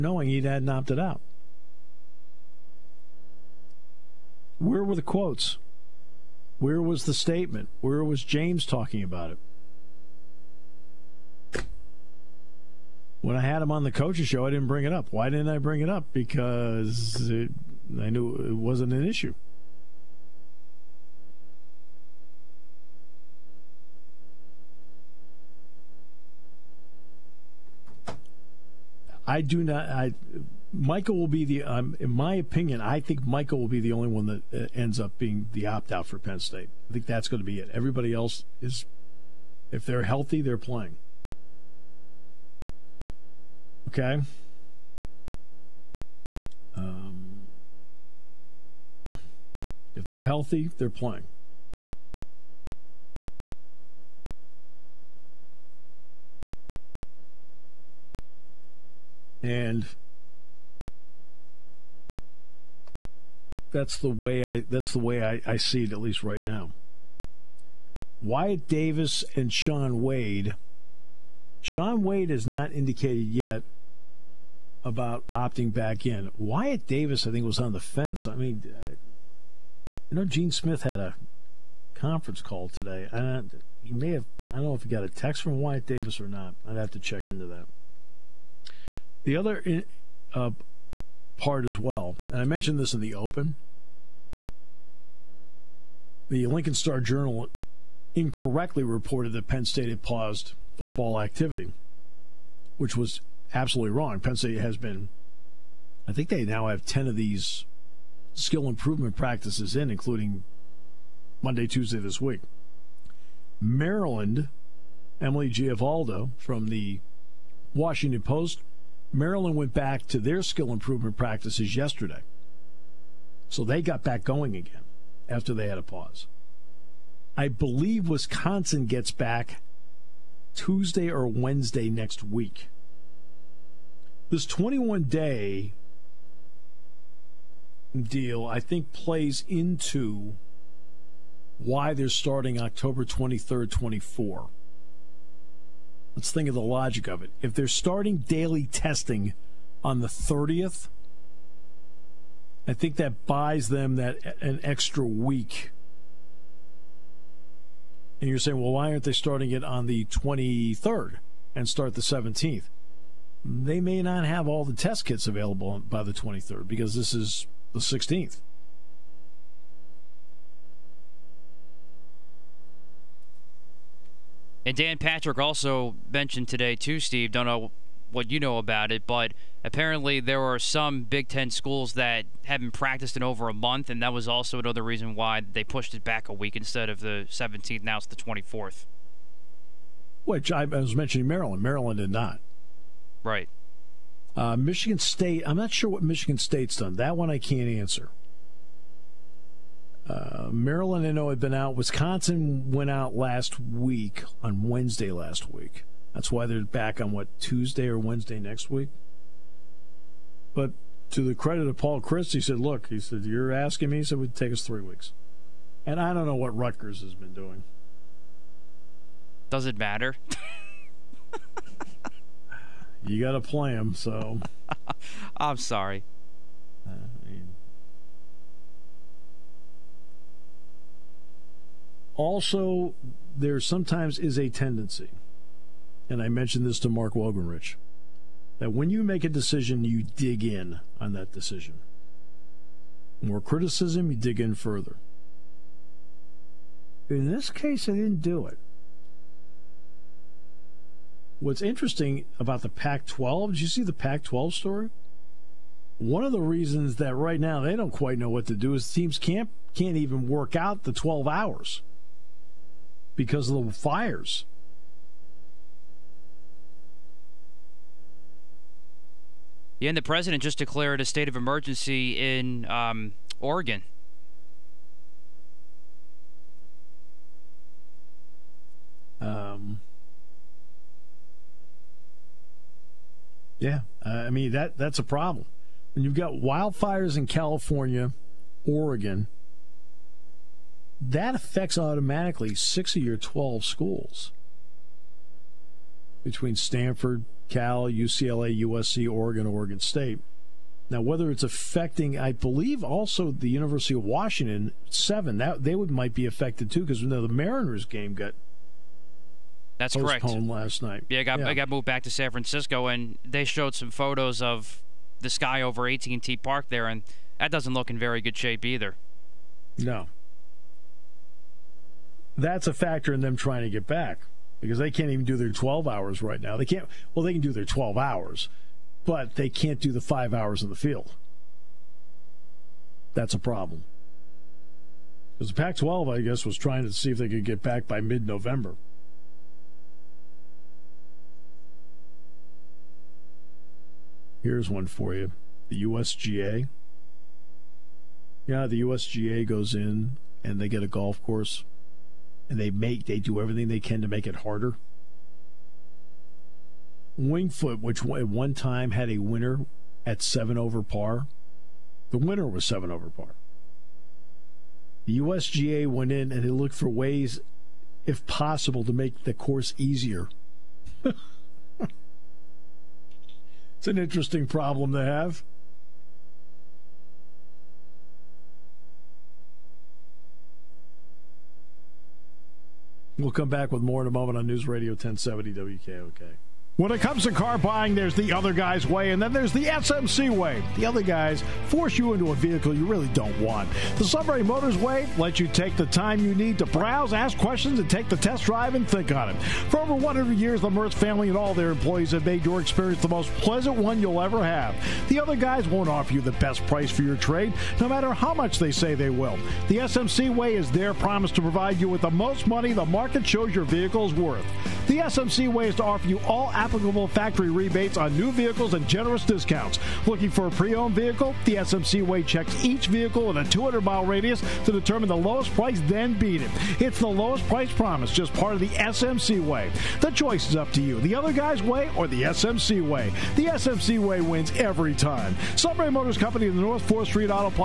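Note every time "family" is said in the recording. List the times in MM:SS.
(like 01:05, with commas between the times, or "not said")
06:40.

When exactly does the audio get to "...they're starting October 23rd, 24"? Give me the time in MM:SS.
02:21.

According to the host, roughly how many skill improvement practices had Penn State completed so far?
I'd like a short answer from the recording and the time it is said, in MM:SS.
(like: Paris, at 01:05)
10, at 01:46.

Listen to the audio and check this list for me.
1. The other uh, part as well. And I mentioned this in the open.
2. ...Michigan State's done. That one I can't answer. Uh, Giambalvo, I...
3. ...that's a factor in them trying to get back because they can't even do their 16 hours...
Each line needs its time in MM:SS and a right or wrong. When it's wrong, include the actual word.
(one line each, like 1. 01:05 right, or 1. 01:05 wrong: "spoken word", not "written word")
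1. 01:29 right
2. 03:16 wrong: "Maryland", not "Giambalvo"
3. 05:22 wrong: "12", not "16".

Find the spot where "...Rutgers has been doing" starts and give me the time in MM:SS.
03:36.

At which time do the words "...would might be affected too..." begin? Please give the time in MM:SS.
05:05.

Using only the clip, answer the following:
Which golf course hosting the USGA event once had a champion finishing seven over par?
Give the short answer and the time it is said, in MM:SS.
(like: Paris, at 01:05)
Winged Foot, at 05:57.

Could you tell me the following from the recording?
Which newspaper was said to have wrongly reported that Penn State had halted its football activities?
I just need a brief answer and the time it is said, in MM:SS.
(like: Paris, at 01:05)
Lincoln Star Journal, at 01:36.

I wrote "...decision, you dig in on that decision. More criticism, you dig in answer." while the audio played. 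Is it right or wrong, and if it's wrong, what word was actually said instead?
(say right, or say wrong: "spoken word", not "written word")
wrong: "further", not "answer".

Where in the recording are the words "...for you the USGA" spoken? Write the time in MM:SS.
05:44.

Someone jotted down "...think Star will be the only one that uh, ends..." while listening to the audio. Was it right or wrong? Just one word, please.
wrong.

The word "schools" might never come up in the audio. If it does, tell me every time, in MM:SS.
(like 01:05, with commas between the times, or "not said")
03:01, 04:53.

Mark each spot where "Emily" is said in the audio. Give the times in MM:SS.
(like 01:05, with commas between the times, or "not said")
01:55.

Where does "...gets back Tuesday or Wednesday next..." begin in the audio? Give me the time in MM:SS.
02:08.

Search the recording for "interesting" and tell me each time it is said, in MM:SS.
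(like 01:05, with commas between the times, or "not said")
04:11, 06:13.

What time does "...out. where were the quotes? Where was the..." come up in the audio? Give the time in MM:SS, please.
00:00.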